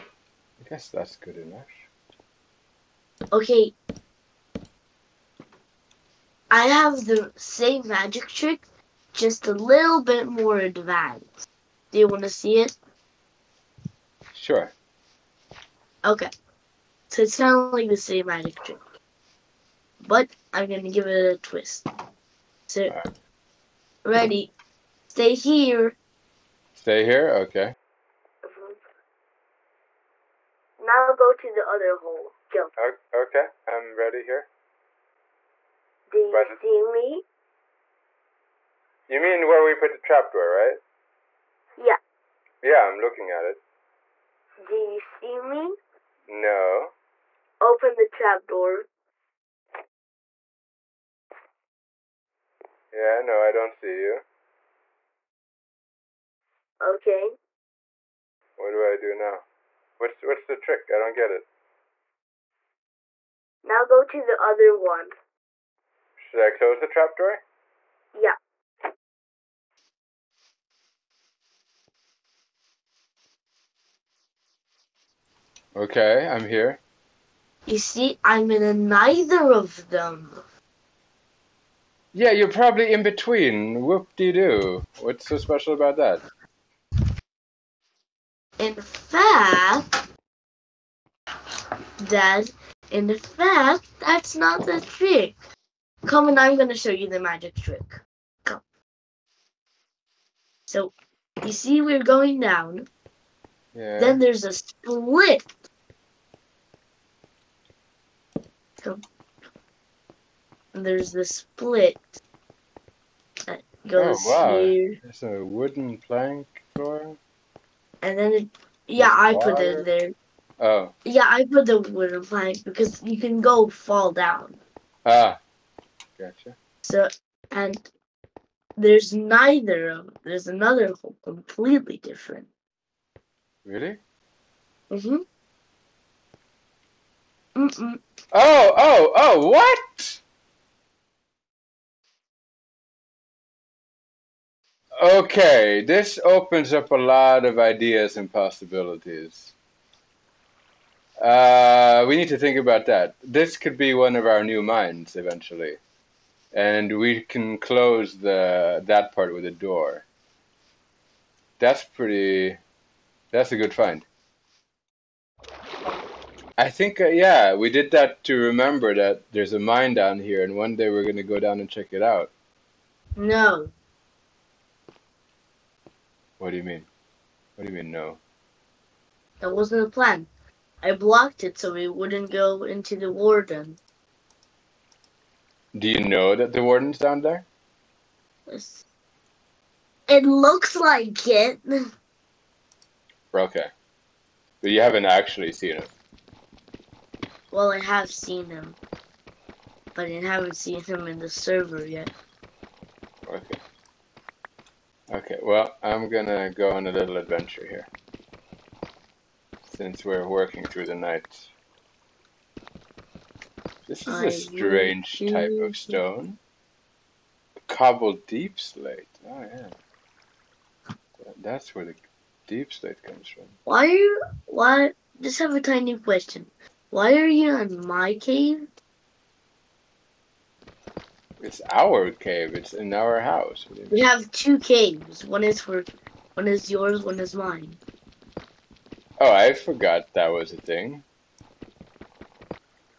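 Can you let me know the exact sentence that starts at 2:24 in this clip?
Okay, this opens up a lot of ideas and possibilities.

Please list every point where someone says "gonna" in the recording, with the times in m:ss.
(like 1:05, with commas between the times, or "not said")
2:51, 3:26.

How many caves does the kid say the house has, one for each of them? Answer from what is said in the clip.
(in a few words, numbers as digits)
2.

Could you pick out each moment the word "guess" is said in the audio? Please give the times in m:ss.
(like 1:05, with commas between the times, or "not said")
0:00.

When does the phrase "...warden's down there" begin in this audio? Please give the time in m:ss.
3:06.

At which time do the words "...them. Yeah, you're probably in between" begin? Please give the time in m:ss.
1:19.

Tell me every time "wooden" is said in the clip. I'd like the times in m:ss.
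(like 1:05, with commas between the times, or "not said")
1:55, 2:01.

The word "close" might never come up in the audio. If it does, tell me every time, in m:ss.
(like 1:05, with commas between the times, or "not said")
1:06, 2:37.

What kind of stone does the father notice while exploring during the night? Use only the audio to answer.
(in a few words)
Cobble deepslate.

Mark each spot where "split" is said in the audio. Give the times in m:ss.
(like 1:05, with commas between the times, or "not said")
1:44, 1:51.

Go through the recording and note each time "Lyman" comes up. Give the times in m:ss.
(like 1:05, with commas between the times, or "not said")
not said.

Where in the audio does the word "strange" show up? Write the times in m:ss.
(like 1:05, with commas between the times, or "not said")
3:34.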